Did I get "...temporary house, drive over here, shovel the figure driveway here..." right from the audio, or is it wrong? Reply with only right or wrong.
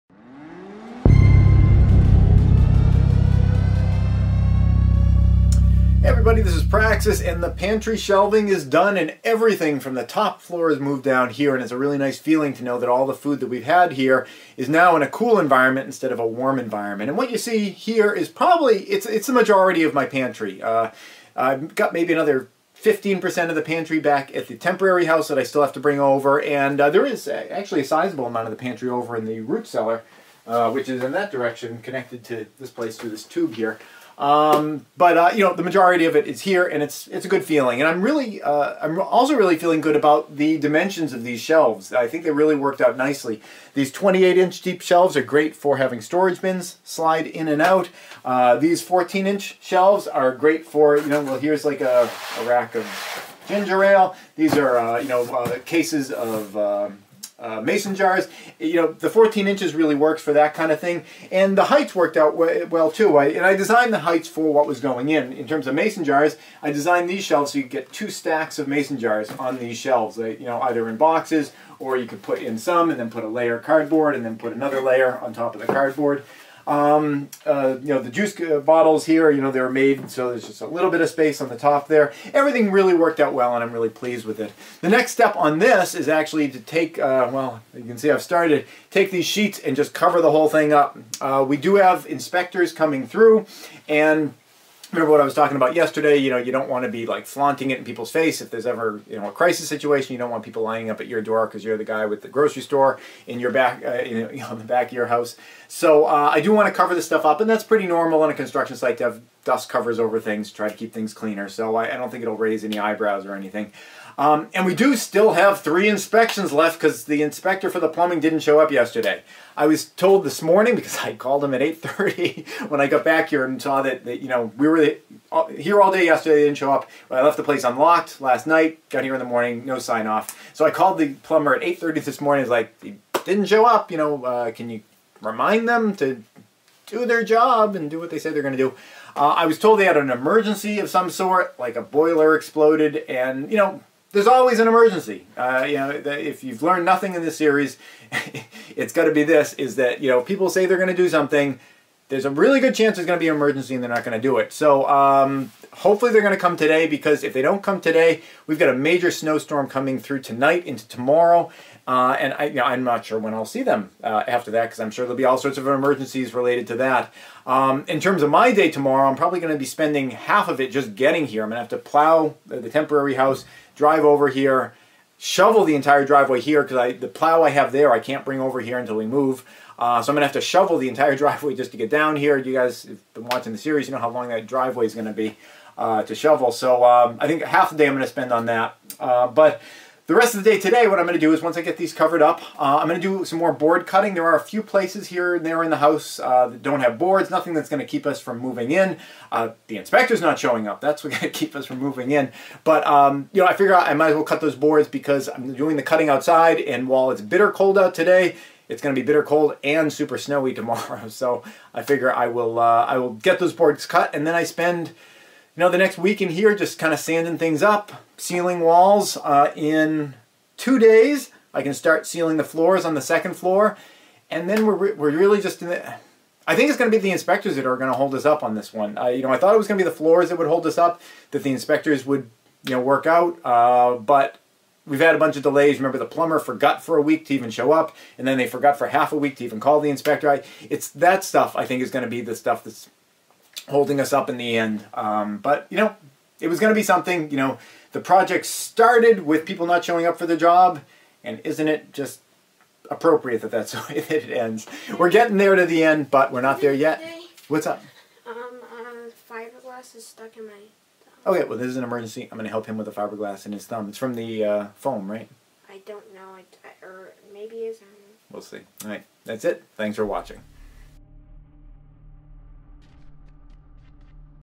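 wrong.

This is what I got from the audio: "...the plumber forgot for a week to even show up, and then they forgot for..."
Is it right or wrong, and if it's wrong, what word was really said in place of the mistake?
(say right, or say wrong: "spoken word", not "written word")
right.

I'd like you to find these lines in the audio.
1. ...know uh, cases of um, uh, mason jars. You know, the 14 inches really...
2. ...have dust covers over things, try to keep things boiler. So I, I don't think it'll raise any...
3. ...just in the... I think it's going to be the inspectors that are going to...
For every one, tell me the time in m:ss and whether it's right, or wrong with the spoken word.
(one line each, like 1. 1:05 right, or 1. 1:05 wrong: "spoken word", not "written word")
1. 0:55 right
2. 1:49 wrong: "cleaner", not "boiler"
3. 3:45 right.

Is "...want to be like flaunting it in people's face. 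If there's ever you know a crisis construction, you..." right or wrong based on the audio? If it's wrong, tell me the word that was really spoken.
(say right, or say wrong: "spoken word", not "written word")
wrong: "situation", not "construction".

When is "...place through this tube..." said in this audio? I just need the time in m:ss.
0:32.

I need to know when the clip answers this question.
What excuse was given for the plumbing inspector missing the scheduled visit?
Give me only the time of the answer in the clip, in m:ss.
2:21.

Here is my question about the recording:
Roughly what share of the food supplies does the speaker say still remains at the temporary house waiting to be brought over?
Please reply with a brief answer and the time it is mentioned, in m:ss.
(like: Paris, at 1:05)
15%, at 0:22.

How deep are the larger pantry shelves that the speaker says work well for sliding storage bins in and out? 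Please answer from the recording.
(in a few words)
28 inches.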